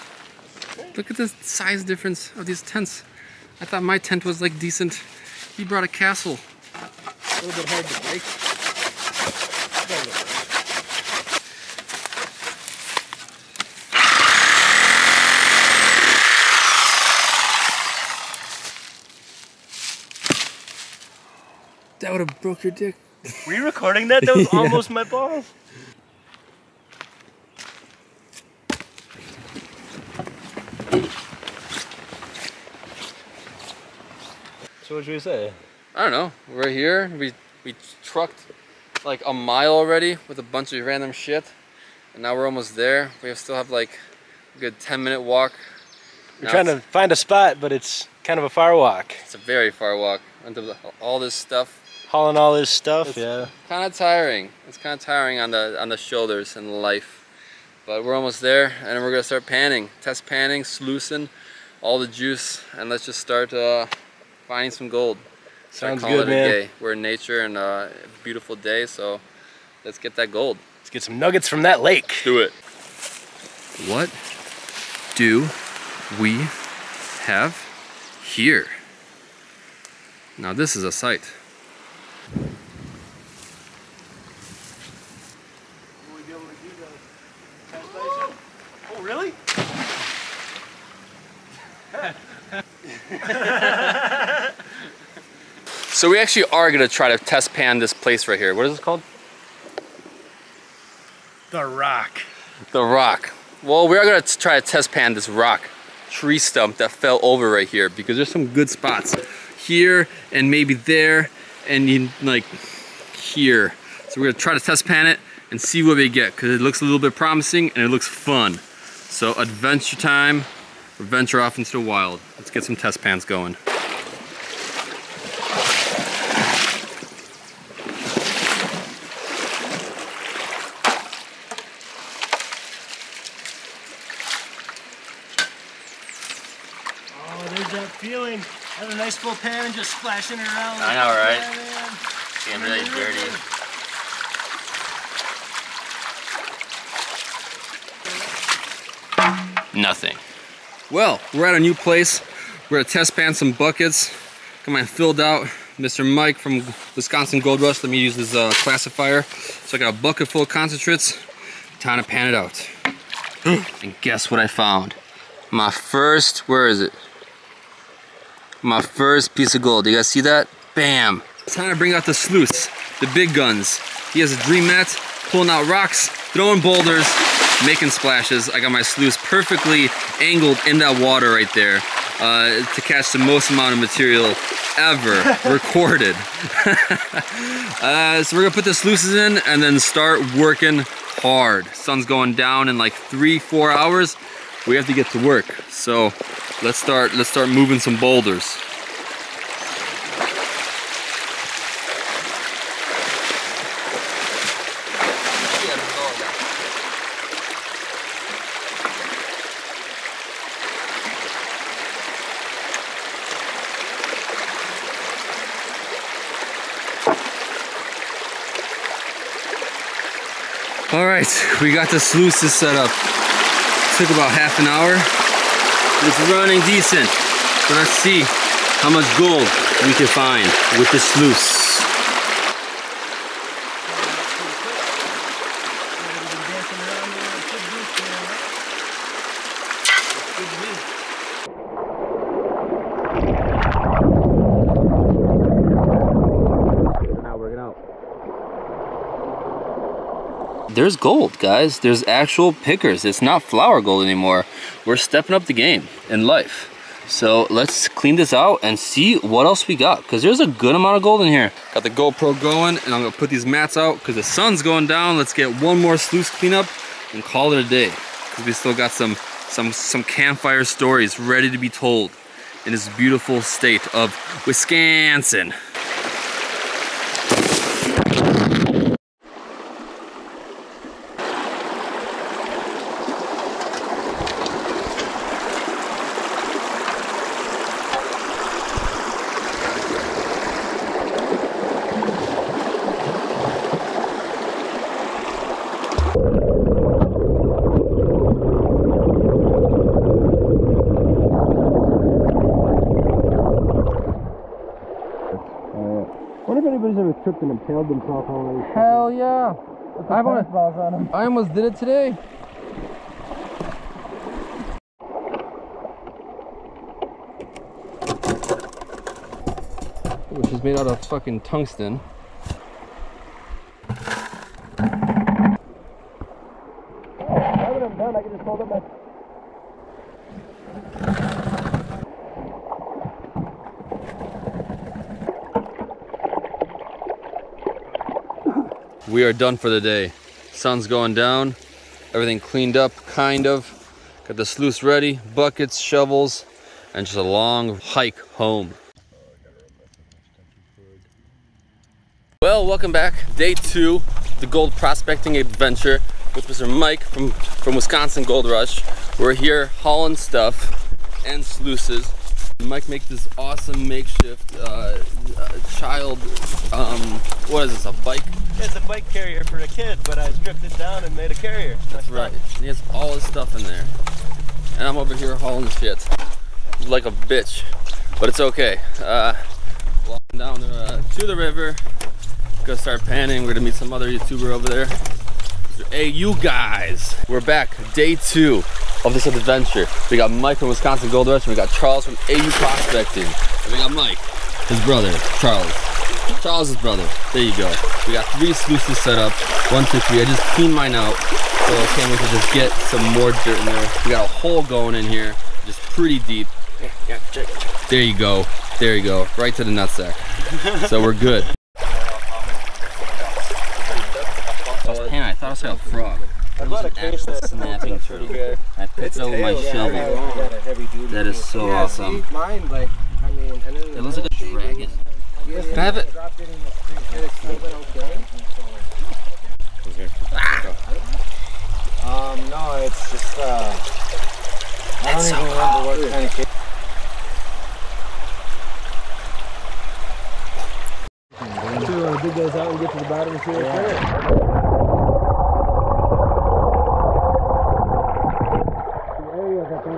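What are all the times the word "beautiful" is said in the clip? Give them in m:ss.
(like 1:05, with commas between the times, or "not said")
1:08, 4:32.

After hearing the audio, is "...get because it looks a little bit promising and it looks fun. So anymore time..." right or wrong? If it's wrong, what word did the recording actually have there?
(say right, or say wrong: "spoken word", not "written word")
wrong: "adventure", not "anymore".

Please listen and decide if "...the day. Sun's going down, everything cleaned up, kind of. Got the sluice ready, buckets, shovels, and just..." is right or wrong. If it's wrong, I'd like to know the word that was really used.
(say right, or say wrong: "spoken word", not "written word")
right.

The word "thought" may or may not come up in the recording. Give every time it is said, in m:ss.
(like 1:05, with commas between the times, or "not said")
0:03, 6:55.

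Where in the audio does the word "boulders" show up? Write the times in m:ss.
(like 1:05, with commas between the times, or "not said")
2:56, 3:17.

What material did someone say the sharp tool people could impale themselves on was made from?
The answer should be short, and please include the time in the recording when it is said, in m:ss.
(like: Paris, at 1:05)
tungsten, at 5:21.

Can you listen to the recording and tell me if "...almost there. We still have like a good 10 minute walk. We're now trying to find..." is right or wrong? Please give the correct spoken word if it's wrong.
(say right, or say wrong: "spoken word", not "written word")
right.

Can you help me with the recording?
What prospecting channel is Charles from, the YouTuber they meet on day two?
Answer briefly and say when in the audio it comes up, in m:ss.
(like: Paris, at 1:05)
AU Prospecting, at 6:32.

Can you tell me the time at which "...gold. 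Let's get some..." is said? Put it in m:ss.
1:10.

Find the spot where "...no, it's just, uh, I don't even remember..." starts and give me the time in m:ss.
7:12.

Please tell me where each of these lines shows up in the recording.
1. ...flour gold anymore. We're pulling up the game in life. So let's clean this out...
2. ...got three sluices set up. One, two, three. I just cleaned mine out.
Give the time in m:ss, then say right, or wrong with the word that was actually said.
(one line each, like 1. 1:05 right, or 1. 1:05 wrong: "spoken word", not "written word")
1. 4:13 wrong: "stepping", not "pulling"
2. 6:38 right.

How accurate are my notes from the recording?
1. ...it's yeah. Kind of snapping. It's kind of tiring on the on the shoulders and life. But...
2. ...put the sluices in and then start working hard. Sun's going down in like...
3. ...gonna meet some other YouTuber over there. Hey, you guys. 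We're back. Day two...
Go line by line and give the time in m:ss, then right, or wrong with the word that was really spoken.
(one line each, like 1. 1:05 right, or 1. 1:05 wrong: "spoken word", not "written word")
1. 0:53 wrong: "tiring", not "snapping"
2. 3:08 right
3. 6:23 right.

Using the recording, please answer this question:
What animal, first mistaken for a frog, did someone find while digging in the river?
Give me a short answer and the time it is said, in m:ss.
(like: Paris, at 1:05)
snapping turtle, at 6:57.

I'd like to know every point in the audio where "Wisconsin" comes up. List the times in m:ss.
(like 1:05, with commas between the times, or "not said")
2:36, 4:34, 5:57, 6:30.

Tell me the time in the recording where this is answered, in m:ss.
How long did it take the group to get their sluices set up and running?
3:44.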